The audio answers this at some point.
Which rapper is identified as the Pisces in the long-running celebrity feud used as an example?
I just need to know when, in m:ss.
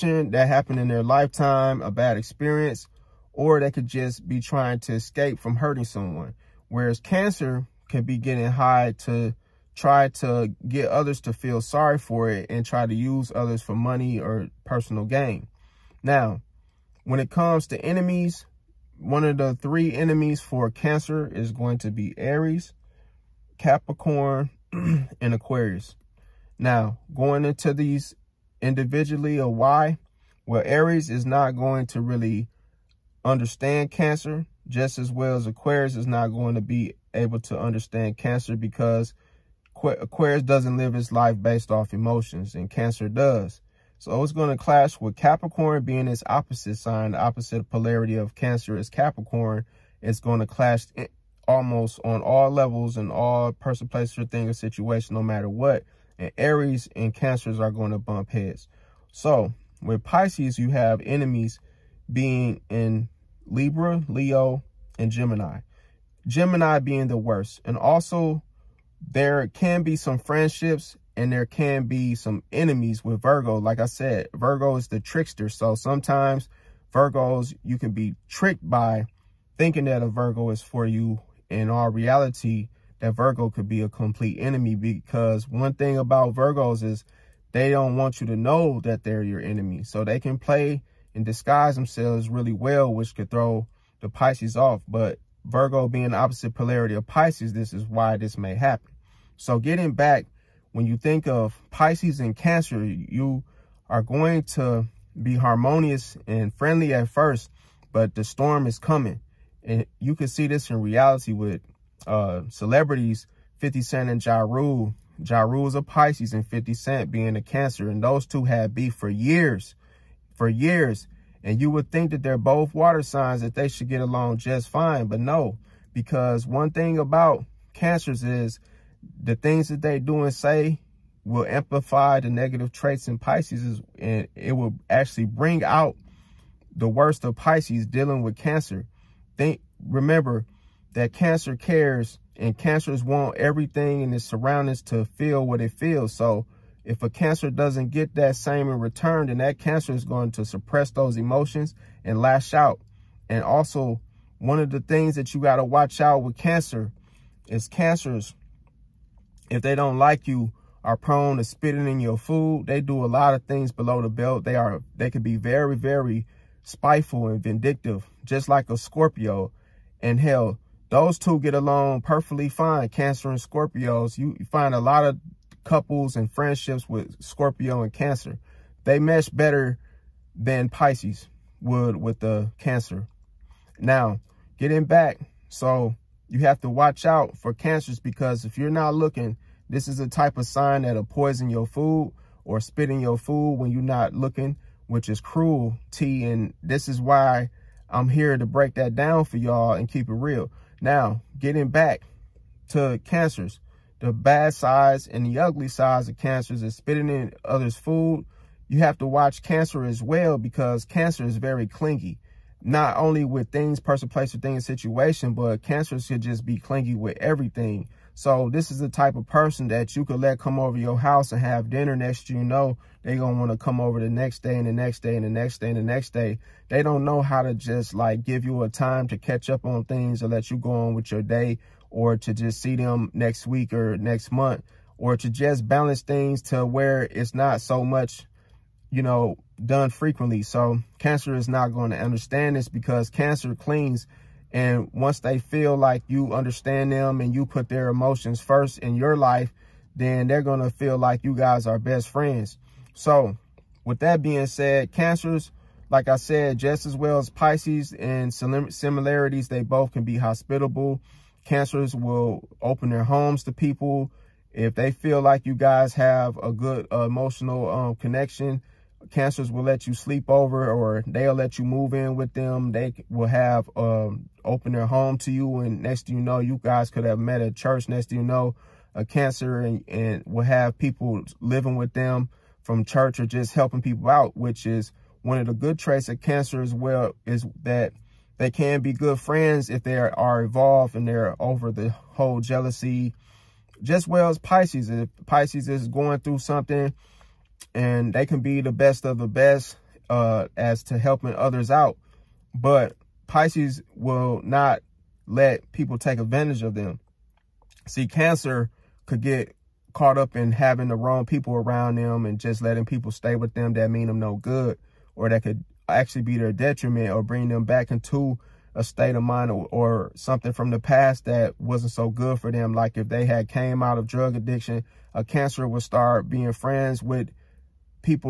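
1:55.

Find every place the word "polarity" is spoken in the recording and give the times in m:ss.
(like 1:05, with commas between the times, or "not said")
0:47, 1:36.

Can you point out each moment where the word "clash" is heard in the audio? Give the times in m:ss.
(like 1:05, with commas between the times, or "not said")
0:44, 0:50.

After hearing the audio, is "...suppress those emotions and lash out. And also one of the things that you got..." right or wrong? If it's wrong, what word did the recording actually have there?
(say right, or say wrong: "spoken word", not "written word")
right.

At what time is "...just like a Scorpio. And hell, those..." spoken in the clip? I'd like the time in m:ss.
2:48.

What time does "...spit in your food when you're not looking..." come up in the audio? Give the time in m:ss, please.
3:12.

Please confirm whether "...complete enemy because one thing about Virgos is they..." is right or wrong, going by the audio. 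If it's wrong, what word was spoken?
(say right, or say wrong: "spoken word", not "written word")
right.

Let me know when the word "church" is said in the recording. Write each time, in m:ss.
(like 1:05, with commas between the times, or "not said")
4:37, 4:42.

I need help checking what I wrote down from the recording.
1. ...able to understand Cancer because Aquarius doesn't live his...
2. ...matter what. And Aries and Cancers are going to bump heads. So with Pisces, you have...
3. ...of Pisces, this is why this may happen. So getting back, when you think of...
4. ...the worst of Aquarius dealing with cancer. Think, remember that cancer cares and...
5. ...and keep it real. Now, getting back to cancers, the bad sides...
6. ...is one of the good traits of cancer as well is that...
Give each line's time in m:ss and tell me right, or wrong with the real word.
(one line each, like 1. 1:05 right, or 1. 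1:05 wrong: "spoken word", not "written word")
1. 0:37 right
2. 0:55 right
3. 1:36 right
4. 2:16 wrong: "Pisces", not "Aquarius"
5. 3:19 right
6. 4:44 right.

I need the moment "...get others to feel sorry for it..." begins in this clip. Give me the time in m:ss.
0:10.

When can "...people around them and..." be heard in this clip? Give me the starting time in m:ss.
5:11.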